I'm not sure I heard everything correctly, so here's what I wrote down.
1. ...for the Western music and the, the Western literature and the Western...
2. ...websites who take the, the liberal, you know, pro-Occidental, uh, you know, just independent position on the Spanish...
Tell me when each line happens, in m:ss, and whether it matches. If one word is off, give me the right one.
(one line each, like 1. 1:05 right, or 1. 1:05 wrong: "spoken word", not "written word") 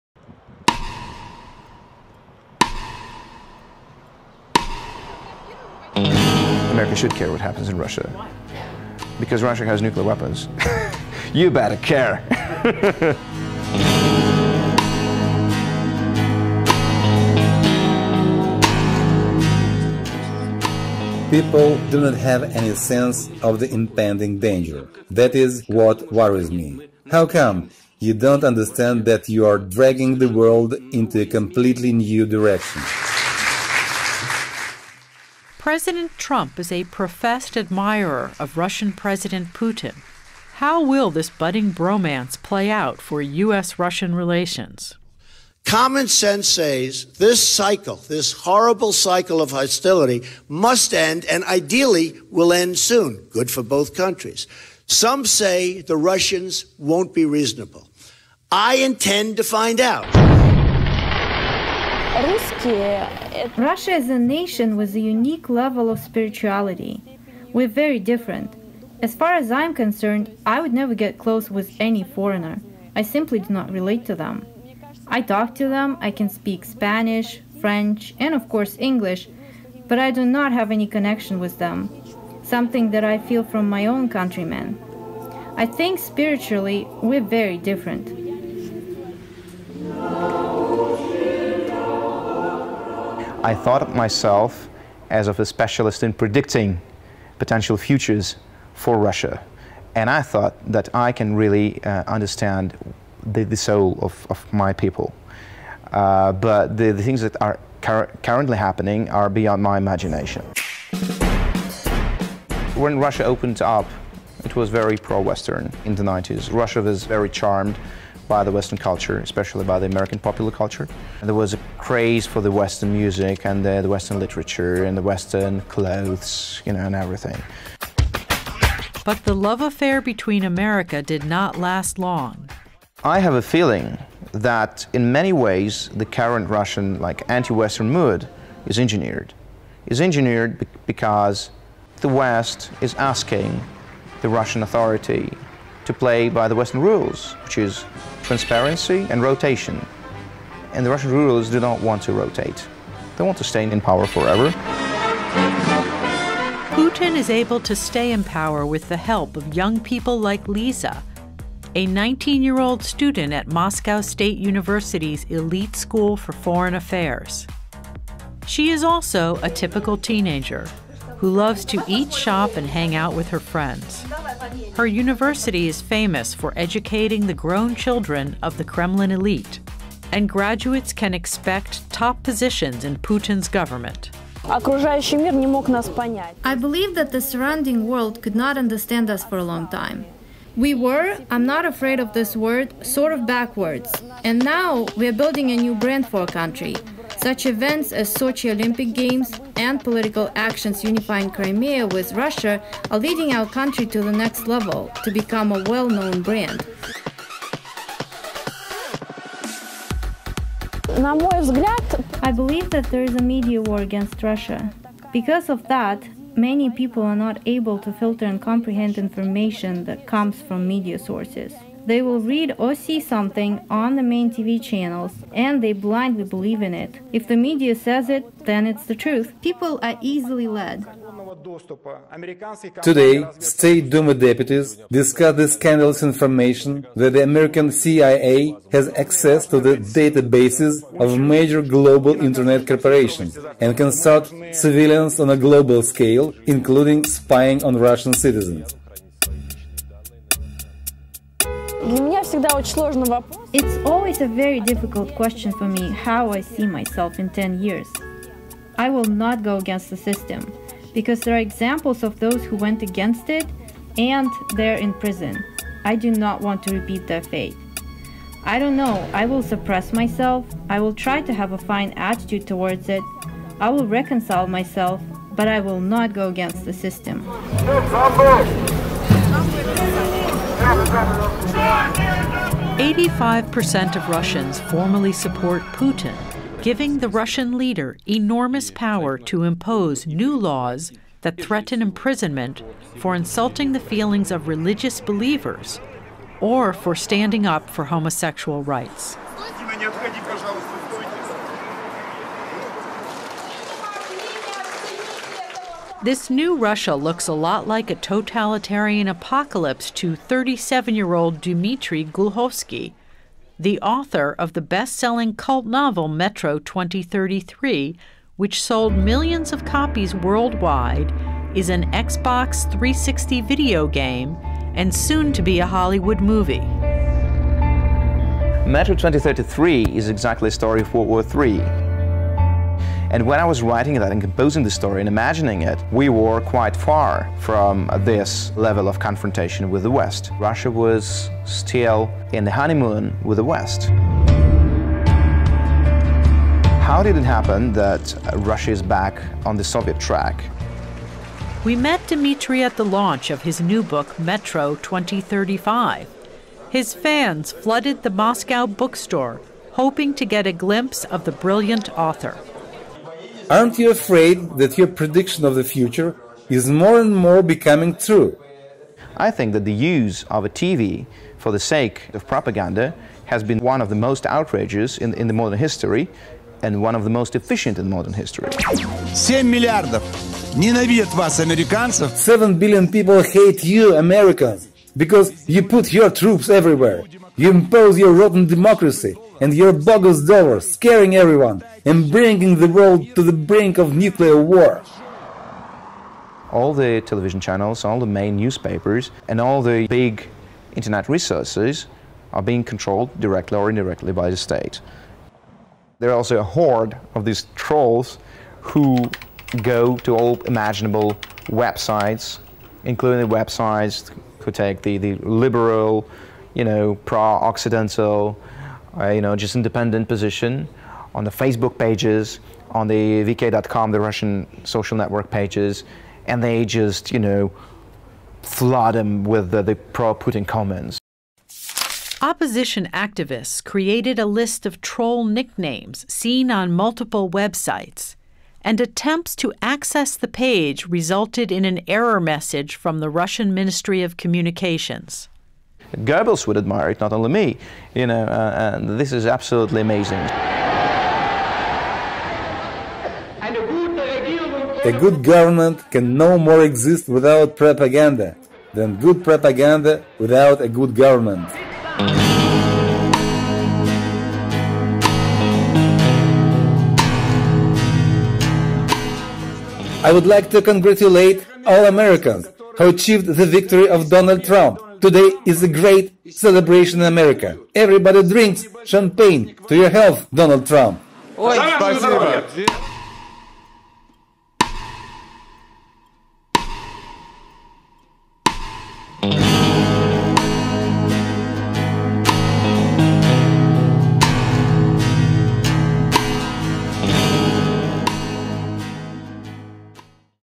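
1. 2:02 right
2. 6:53 wrong: "Facebook", not "Spanish".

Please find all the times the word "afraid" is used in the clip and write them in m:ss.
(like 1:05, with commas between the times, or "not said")
3:11, 6:03.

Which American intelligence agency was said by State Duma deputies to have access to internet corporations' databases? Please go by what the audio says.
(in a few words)
CIA.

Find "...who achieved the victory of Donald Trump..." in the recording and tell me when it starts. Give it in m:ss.
7:52.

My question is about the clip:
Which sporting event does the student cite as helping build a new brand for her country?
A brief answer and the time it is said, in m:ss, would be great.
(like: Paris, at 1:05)
Sochi Olympic Games, at 3:18.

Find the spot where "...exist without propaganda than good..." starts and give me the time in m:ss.
7:36.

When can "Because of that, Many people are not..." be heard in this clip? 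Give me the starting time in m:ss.
3:35.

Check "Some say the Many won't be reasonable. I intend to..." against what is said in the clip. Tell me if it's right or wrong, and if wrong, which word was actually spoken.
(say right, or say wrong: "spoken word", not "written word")
wrong: "Russians", not "Many".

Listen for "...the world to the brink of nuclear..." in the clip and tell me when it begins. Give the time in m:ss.
6:32.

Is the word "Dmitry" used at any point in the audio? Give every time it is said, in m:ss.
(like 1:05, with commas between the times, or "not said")
5:11, 5:52.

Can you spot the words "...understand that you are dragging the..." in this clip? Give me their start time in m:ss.
0:28.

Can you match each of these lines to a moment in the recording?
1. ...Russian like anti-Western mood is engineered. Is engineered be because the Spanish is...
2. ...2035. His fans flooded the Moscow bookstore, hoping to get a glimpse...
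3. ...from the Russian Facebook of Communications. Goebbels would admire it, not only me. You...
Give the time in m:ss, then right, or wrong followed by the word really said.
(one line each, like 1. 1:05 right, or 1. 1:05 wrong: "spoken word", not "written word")
1. 2:16 wrong: "West", not "Spanish"
2. 5:54 right
3. 7:22 wrong: "Ministry", not "Facebook".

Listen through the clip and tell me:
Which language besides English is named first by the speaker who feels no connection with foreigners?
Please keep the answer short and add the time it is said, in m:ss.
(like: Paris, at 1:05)
Spanish, at 1:16.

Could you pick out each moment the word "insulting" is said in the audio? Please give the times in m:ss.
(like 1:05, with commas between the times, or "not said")
4:53.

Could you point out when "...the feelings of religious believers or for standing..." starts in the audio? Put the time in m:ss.
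4:53.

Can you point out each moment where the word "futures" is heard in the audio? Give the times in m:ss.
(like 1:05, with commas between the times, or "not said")
1:37, 6:05.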